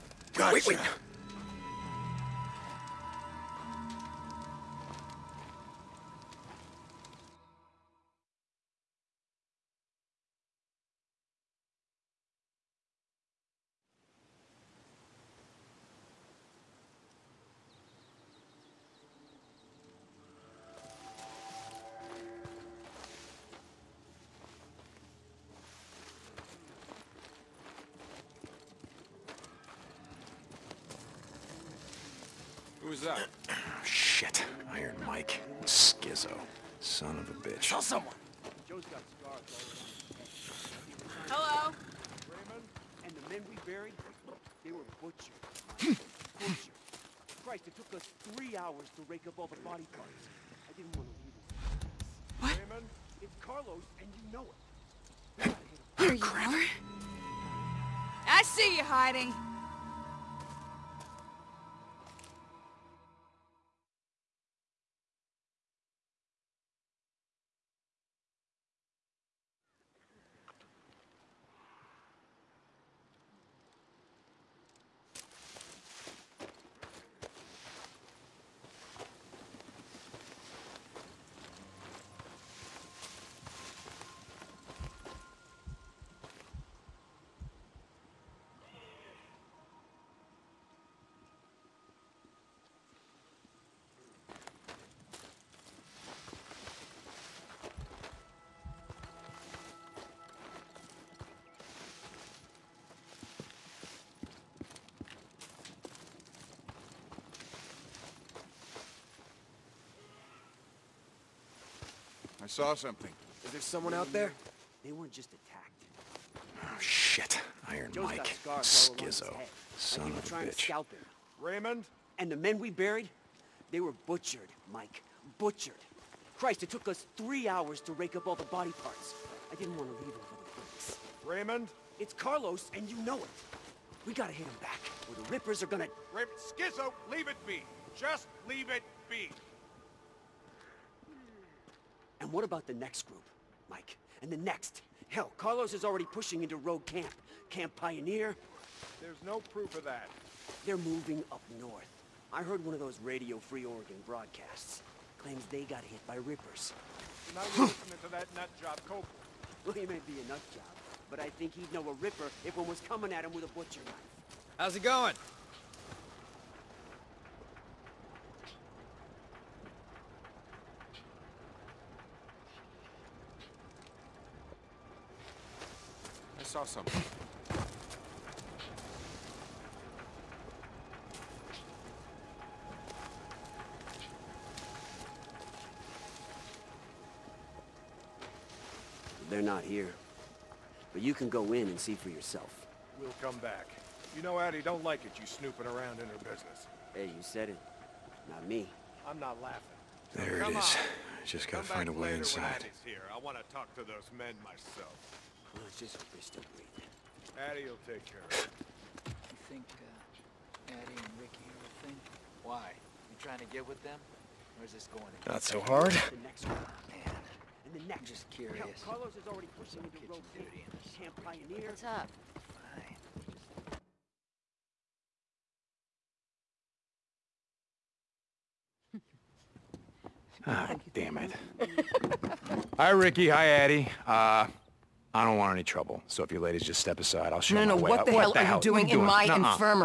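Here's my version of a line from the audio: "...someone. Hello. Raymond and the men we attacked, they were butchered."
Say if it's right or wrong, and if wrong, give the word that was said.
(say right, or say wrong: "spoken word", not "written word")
wrong: "buried", not "attacked".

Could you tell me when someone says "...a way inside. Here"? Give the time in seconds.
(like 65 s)
201 s.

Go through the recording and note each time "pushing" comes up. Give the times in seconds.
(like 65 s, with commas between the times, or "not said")
146 s, 219 s.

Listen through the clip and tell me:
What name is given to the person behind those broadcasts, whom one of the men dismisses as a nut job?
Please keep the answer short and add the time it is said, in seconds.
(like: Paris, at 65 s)
Cope, at 158 s.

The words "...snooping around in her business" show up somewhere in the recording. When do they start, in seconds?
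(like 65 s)
195 s.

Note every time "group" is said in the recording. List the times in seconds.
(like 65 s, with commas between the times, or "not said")
143 s.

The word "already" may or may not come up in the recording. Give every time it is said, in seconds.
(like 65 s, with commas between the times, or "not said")
145 s, 219 s.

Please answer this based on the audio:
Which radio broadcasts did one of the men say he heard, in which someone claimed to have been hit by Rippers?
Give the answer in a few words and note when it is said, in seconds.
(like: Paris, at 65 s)
Radio Free Oregon, at 153 s.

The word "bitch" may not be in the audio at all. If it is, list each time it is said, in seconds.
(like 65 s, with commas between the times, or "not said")
37 s, 120 s.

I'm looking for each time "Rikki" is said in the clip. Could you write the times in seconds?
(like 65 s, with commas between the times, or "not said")
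211 s, 232 s.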